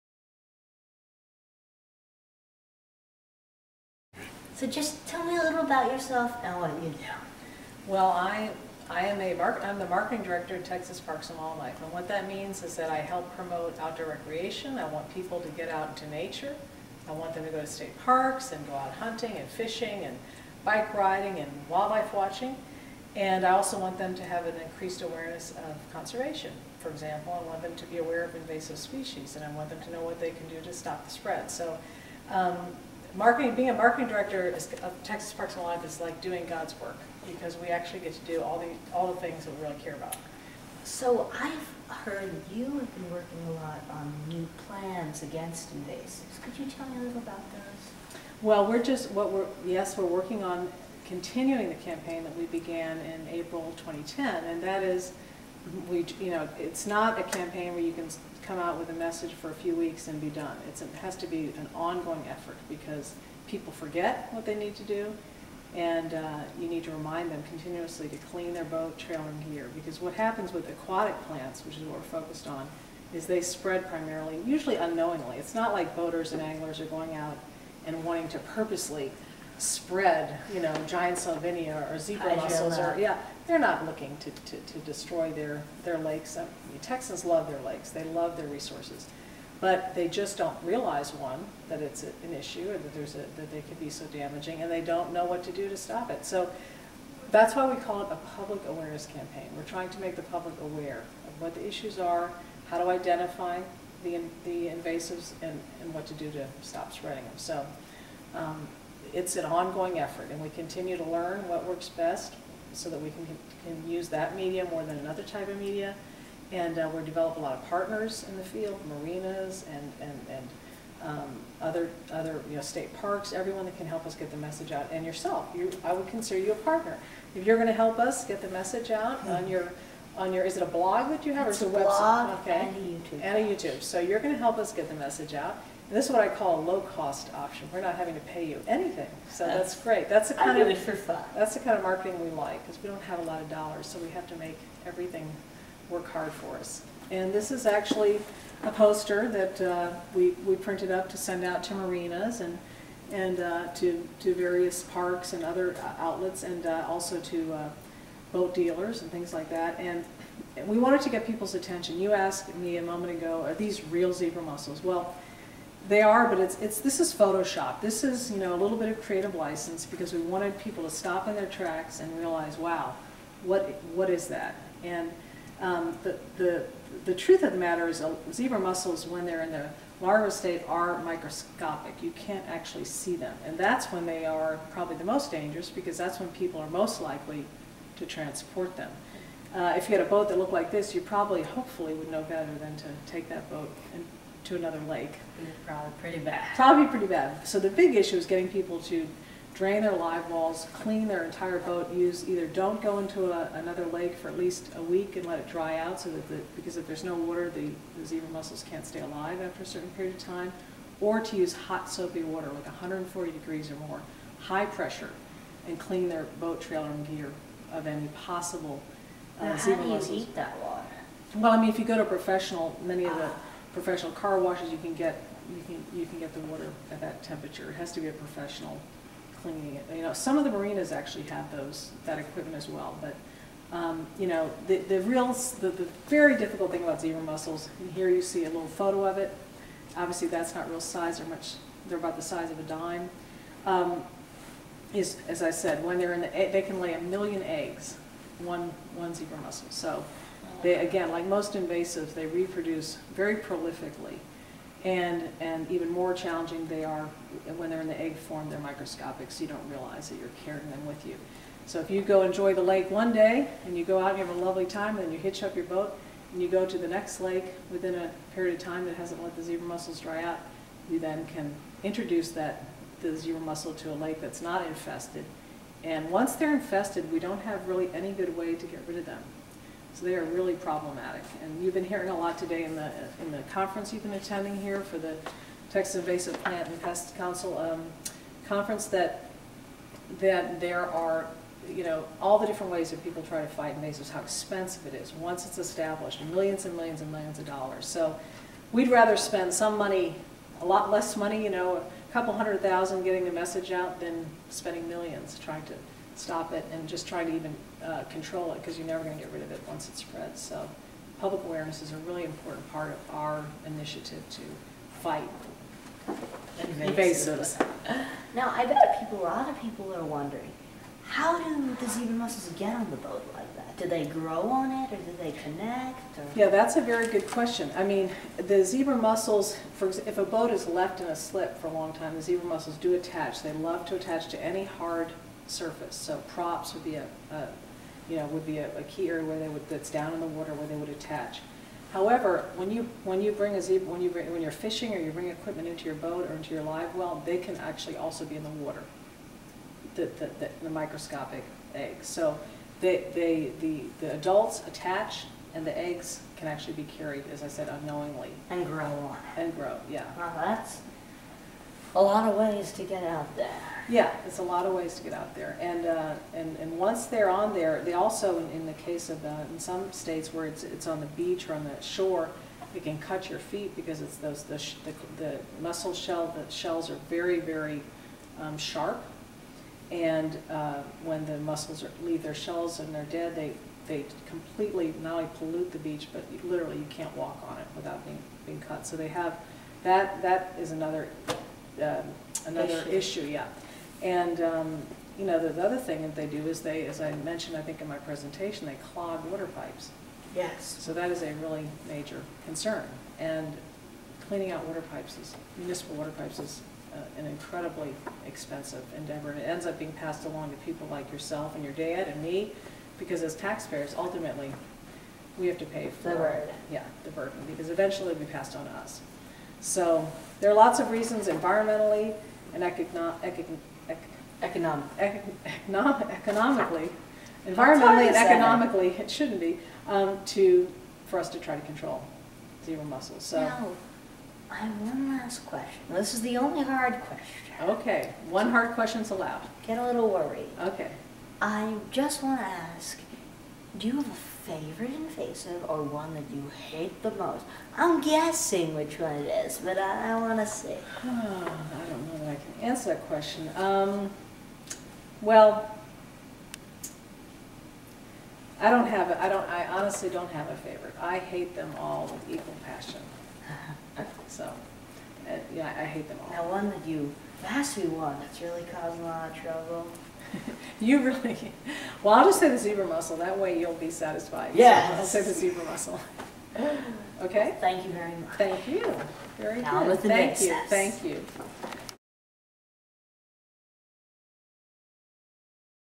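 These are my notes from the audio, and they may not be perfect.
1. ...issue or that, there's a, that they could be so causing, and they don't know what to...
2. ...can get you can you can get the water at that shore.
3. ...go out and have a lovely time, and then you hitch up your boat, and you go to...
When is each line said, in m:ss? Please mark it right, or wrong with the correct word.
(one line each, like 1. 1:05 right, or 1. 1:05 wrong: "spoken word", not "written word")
1. 1:32 wrong: "damaging", not "causing"
2. 3:44 wrong: "temperature", not "shore"
3. 4:23 right.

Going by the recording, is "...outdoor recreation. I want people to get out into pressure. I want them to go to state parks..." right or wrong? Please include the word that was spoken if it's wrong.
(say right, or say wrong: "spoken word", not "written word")
wrong: "nature", not "pressure".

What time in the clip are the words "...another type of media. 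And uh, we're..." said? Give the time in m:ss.
1:54.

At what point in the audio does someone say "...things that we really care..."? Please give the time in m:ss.
0:39.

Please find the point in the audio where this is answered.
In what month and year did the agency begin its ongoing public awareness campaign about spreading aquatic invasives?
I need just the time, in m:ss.
0:53.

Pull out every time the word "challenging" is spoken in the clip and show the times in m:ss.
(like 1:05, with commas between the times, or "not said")
4:16.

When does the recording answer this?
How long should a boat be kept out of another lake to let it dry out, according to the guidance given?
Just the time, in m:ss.
3:24.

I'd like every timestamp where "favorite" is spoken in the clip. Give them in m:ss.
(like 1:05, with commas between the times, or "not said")
7:24, 7:40.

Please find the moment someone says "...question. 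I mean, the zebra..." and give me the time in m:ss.
5:27.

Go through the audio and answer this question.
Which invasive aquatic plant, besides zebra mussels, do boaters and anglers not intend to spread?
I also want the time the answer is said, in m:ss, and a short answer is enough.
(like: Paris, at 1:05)
Giant salvinia, at 1:20.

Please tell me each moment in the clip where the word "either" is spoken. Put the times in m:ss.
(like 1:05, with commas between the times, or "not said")
3:22.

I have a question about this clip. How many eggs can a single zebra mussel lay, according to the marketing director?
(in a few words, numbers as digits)
1,000,000.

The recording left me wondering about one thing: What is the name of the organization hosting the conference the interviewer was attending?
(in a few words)
Texas Invasive Plant and Pest Council.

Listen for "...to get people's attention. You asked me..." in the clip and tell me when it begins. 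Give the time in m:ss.
2:41.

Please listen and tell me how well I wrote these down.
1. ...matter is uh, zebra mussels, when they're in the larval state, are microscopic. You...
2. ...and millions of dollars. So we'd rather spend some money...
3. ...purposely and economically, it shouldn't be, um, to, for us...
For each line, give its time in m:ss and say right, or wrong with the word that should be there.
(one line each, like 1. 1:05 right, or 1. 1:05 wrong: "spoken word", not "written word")
1. 2:57 right
2. 4:57 right
3. 7:07 wrong: "environmentally", not "purposely".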